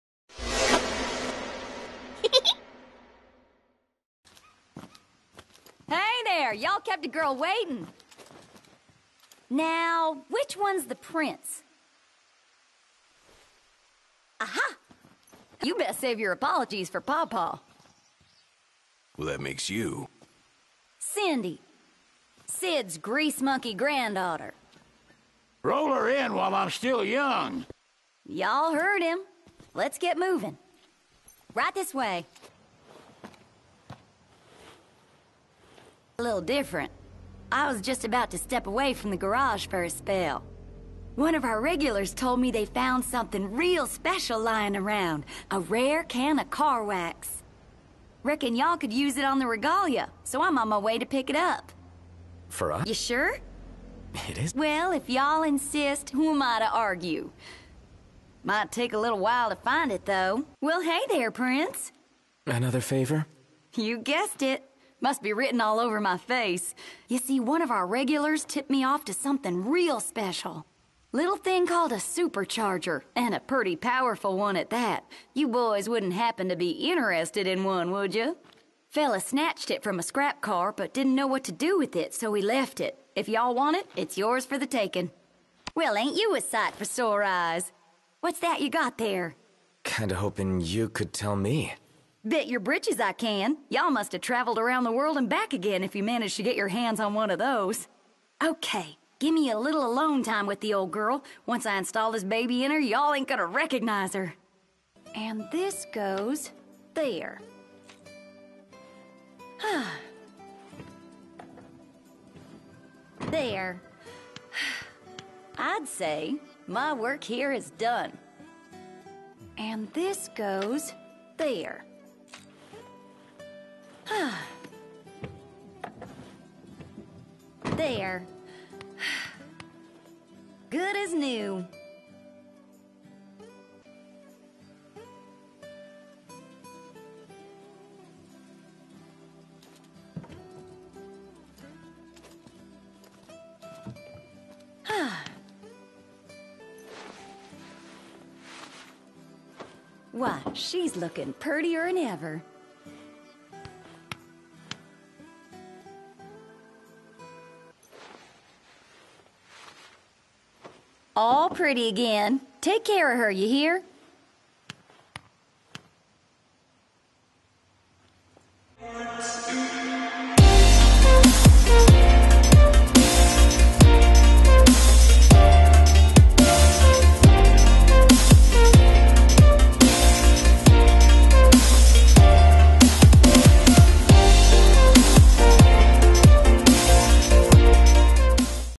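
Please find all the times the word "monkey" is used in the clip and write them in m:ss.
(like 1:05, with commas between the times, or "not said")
0:23.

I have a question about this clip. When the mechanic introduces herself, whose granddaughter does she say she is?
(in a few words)
Sid.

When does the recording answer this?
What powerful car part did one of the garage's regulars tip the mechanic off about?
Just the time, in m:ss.
1:11.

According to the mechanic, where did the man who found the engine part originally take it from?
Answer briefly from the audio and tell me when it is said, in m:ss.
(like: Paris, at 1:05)
A scrap car, at 1:20.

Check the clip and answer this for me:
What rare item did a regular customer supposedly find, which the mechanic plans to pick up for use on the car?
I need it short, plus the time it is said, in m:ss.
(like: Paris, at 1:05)
Car wax, at 0:46.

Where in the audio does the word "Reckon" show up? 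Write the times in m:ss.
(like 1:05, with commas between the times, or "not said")
0:48.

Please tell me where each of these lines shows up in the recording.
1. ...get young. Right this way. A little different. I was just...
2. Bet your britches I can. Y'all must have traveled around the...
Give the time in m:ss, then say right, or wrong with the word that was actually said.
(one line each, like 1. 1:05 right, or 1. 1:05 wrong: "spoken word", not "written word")
1. 0:29 wrong: "moving", not "young"
2. 1:32 right.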